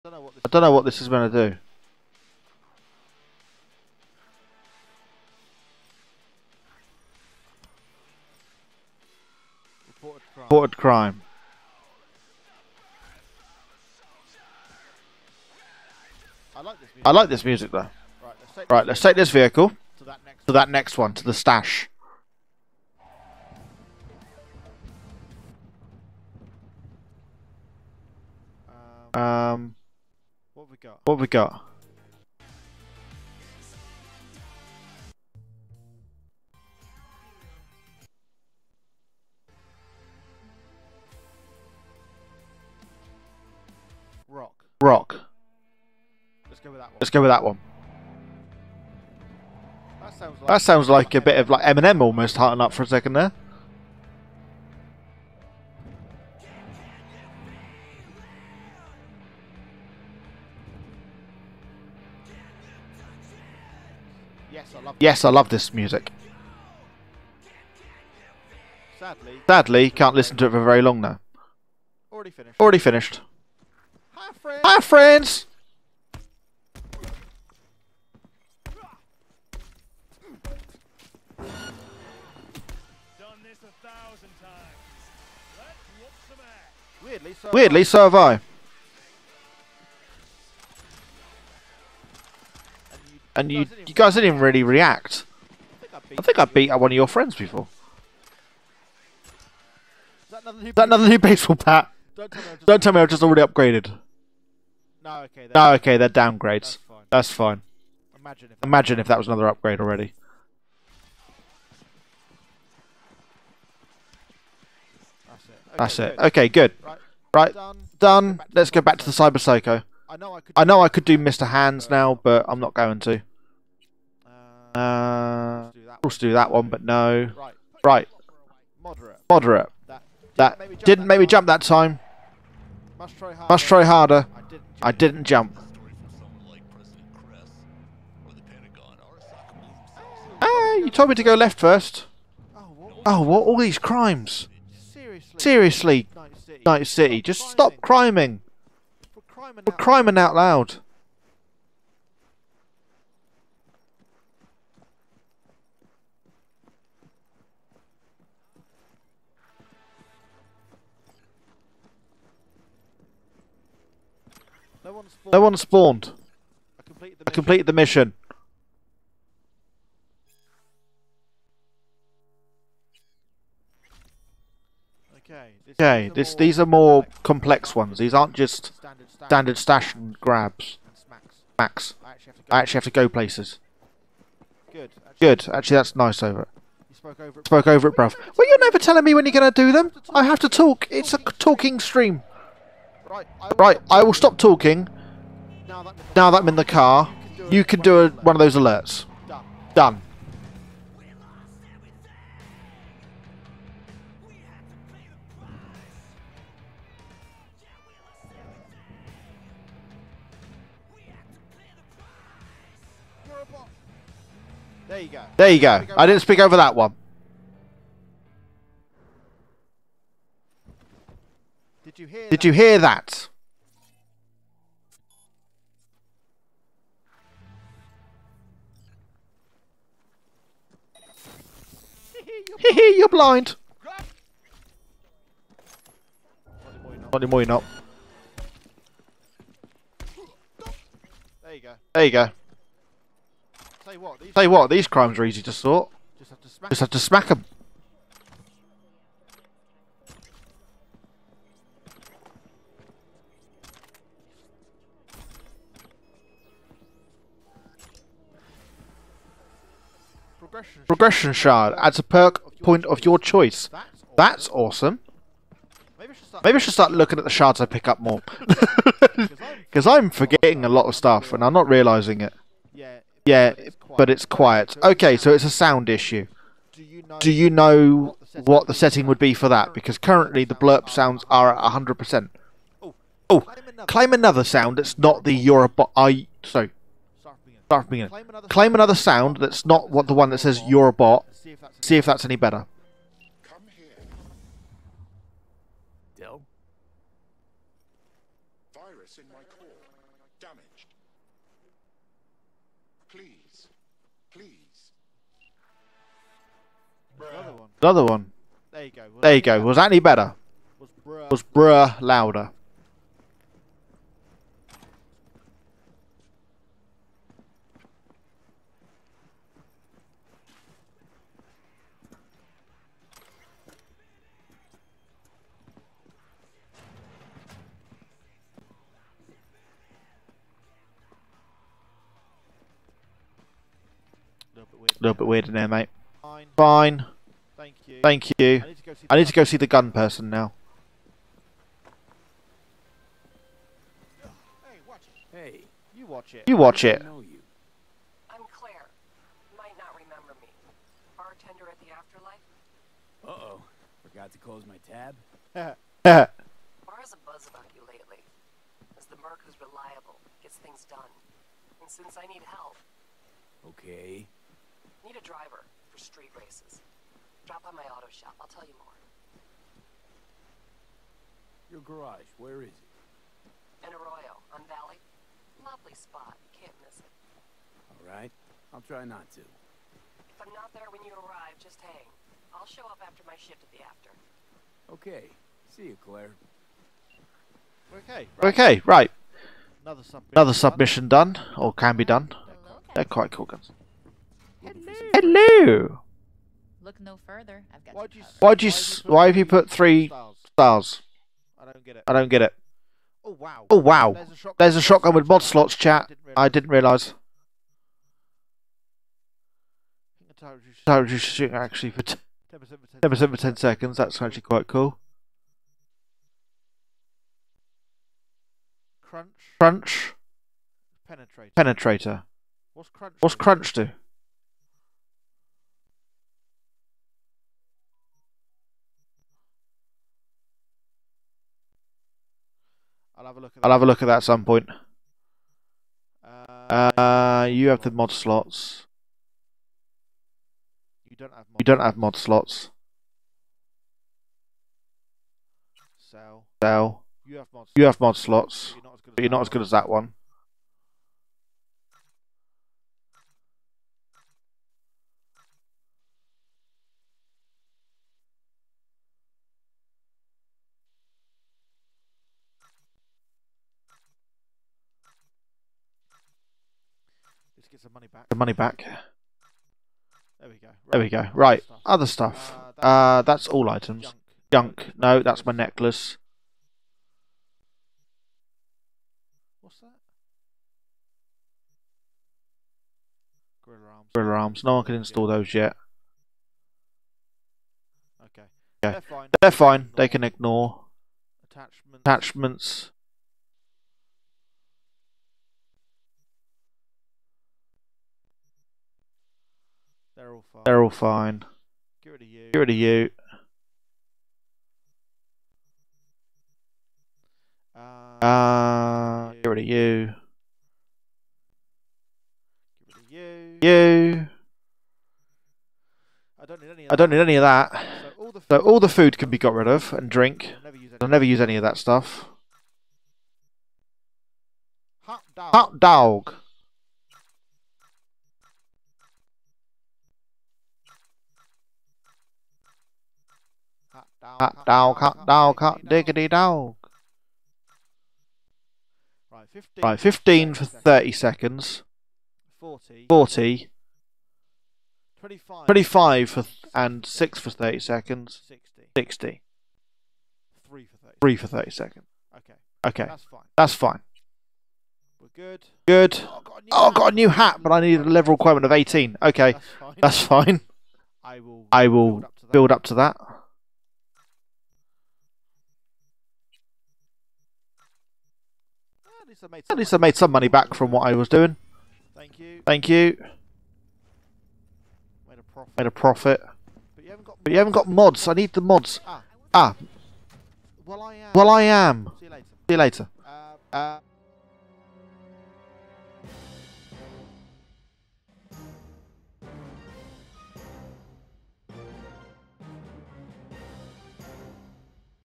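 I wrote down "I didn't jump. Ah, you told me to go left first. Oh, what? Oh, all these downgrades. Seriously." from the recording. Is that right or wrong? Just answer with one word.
wrong.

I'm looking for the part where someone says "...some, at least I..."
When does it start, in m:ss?
9:29.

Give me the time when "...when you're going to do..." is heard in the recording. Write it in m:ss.
3:09.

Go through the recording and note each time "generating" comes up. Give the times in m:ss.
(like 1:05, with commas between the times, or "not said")
not said.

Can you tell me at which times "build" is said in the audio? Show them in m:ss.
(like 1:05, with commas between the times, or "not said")
9:22.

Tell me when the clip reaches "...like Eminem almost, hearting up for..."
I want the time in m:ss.
0:51.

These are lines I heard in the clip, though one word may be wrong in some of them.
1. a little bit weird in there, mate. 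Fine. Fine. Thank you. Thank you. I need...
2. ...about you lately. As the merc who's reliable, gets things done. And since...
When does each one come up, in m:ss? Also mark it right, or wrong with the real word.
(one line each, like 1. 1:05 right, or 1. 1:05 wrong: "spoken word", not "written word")
1. 5:35 right
2. 5:57 right.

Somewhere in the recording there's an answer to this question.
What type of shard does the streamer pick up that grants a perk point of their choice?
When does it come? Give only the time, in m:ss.
4:20.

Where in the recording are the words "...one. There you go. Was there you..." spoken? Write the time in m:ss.
5:08.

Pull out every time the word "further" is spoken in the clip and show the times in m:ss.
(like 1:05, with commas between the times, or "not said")
6:37.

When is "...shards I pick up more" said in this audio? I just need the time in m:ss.
4:27.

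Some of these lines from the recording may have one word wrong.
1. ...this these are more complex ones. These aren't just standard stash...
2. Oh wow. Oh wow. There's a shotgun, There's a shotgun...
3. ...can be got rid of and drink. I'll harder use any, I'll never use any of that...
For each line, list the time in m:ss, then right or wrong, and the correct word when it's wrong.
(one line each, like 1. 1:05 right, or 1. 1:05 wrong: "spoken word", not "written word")
1. 2:56 right
2. 6:43 right
3. 8:39 wrong: "never", not "harder".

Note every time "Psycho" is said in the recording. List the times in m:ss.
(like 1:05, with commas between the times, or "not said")
1:59.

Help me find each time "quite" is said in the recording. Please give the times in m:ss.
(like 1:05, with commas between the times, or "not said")
6:33, 6:54.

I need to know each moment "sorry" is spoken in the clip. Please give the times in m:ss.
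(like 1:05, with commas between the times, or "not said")
4:46.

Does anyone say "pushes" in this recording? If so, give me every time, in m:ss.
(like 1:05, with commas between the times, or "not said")
not said.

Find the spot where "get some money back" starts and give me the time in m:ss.
7:47.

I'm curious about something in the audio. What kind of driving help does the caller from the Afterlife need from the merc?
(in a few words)
Street races.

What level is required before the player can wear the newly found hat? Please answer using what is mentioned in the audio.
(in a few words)
18.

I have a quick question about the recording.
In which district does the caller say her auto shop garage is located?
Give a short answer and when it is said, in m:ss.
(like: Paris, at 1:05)
Arroyo, at 6:13.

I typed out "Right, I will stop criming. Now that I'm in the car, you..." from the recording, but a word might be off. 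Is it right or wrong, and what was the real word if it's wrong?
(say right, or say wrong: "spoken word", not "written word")
wrong: "talking", not "criming".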